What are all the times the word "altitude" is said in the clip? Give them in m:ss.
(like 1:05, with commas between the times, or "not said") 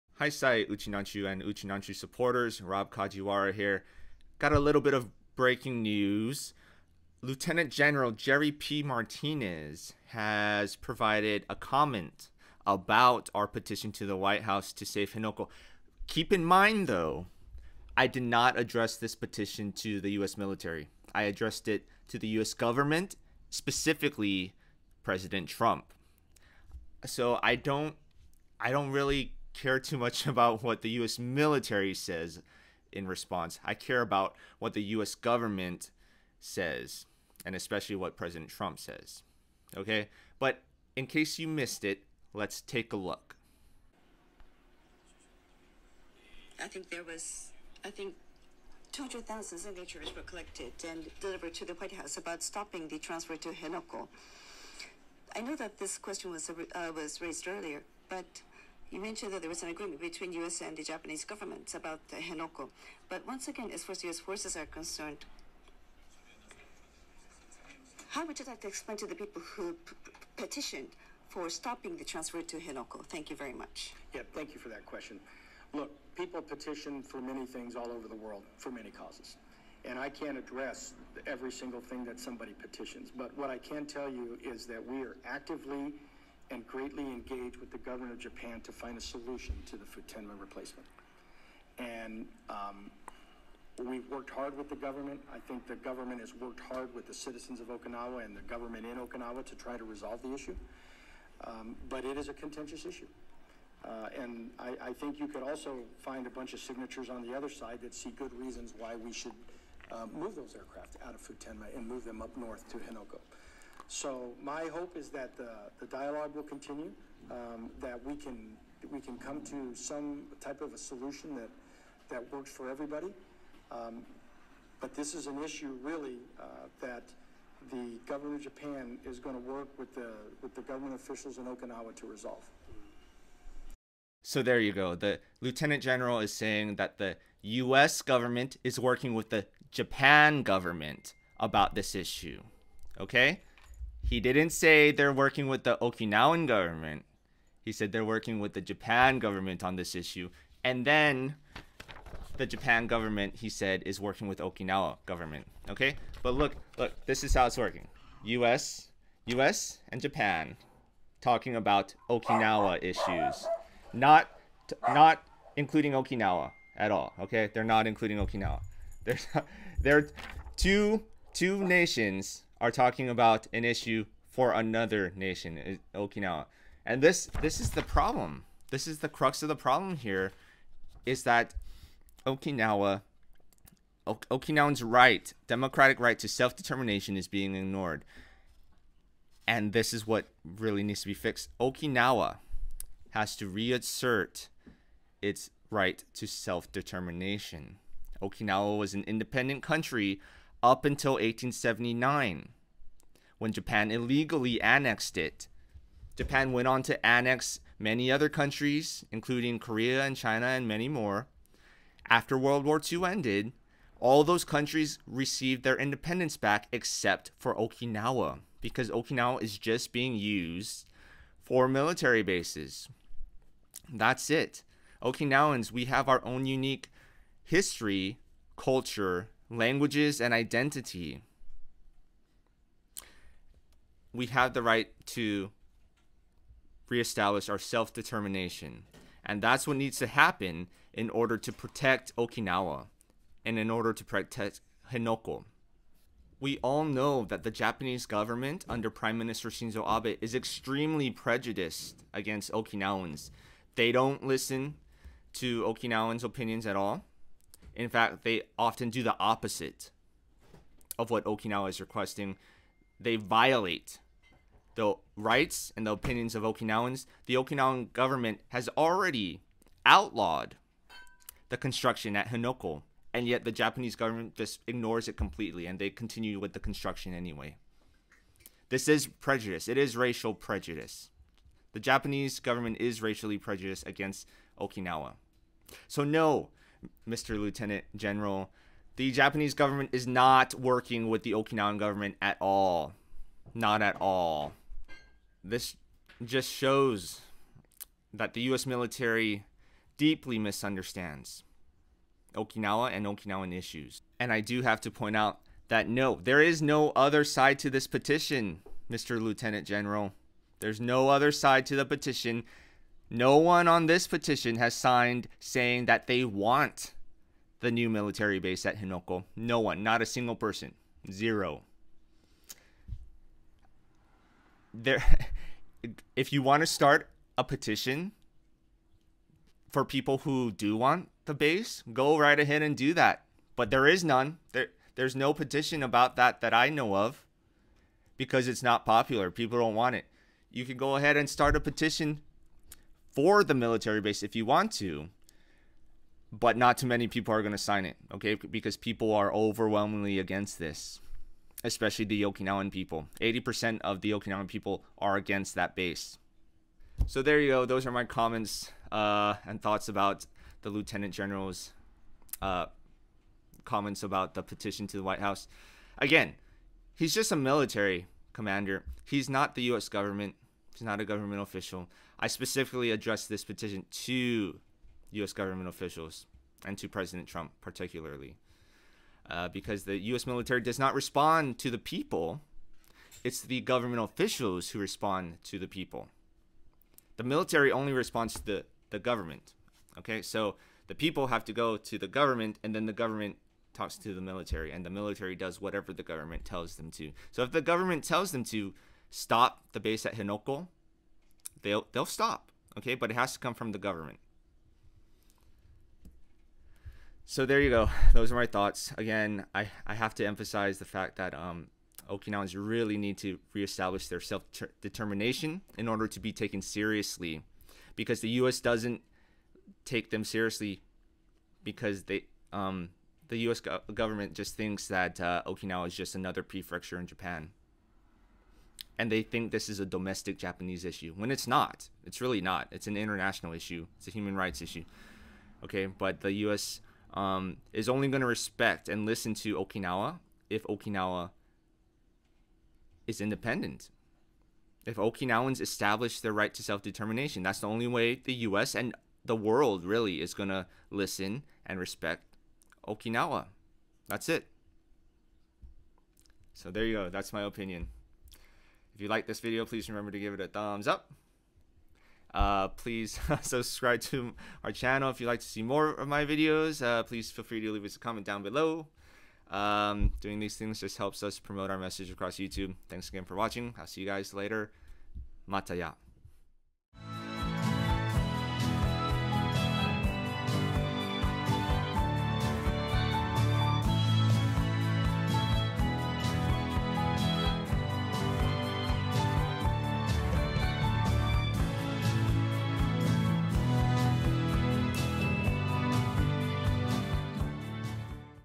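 not said.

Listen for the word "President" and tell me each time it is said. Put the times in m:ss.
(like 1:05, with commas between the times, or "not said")
0:25, 0:38, 6:16.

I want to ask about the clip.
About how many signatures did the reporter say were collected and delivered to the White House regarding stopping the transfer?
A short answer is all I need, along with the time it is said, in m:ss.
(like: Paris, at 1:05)
200,000, at 0:48.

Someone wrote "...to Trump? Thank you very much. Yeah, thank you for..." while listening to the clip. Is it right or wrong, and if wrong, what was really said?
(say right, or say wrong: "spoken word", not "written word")
wrong: "Henoko", not "Trump".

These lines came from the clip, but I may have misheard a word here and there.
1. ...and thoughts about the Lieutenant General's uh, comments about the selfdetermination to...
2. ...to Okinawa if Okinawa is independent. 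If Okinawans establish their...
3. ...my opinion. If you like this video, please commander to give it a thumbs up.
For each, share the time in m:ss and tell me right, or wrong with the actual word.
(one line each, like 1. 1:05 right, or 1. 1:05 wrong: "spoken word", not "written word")
1. 5:59 wrong: "petition", not "selfdetermination"
2. 7:19 right
3. 7:37 wrong: "remember", not "commander".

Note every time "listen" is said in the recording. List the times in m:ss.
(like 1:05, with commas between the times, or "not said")
4:14, 7:19, 7:30.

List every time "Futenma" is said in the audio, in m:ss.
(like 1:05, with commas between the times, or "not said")
1:29, 1:51.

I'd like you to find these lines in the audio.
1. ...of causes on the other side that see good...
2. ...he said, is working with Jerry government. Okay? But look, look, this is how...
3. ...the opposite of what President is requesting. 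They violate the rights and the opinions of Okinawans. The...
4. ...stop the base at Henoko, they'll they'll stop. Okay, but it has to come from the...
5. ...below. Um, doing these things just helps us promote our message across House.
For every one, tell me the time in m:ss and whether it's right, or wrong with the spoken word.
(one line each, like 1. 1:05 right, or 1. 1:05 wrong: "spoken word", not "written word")
1. 1:46 wrong: "signatures", not "causes"
2. 2:33 wrong: "Okinawa", not "Jerry"
3. 4:19 wrong: "Okinawa", not "President"
4. 6:39 right
5. 7:48 wrong: "YouTube", not "House".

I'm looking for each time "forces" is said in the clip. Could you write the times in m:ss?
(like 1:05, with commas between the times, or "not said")
1:04.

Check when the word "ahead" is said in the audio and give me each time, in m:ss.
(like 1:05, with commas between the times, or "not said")
5:32, 5:40.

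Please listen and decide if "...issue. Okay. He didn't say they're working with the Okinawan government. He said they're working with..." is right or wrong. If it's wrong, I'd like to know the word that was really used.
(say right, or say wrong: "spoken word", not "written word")
right.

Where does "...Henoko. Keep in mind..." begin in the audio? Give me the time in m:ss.
0:15.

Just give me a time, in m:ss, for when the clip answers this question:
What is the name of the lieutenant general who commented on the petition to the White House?
0:08.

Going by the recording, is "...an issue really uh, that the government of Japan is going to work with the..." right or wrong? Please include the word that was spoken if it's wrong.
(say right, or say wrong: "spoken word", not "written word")
right.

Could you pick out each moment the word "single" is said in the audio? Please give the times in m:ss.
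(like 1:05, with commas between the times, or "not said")
1:21, 5:20.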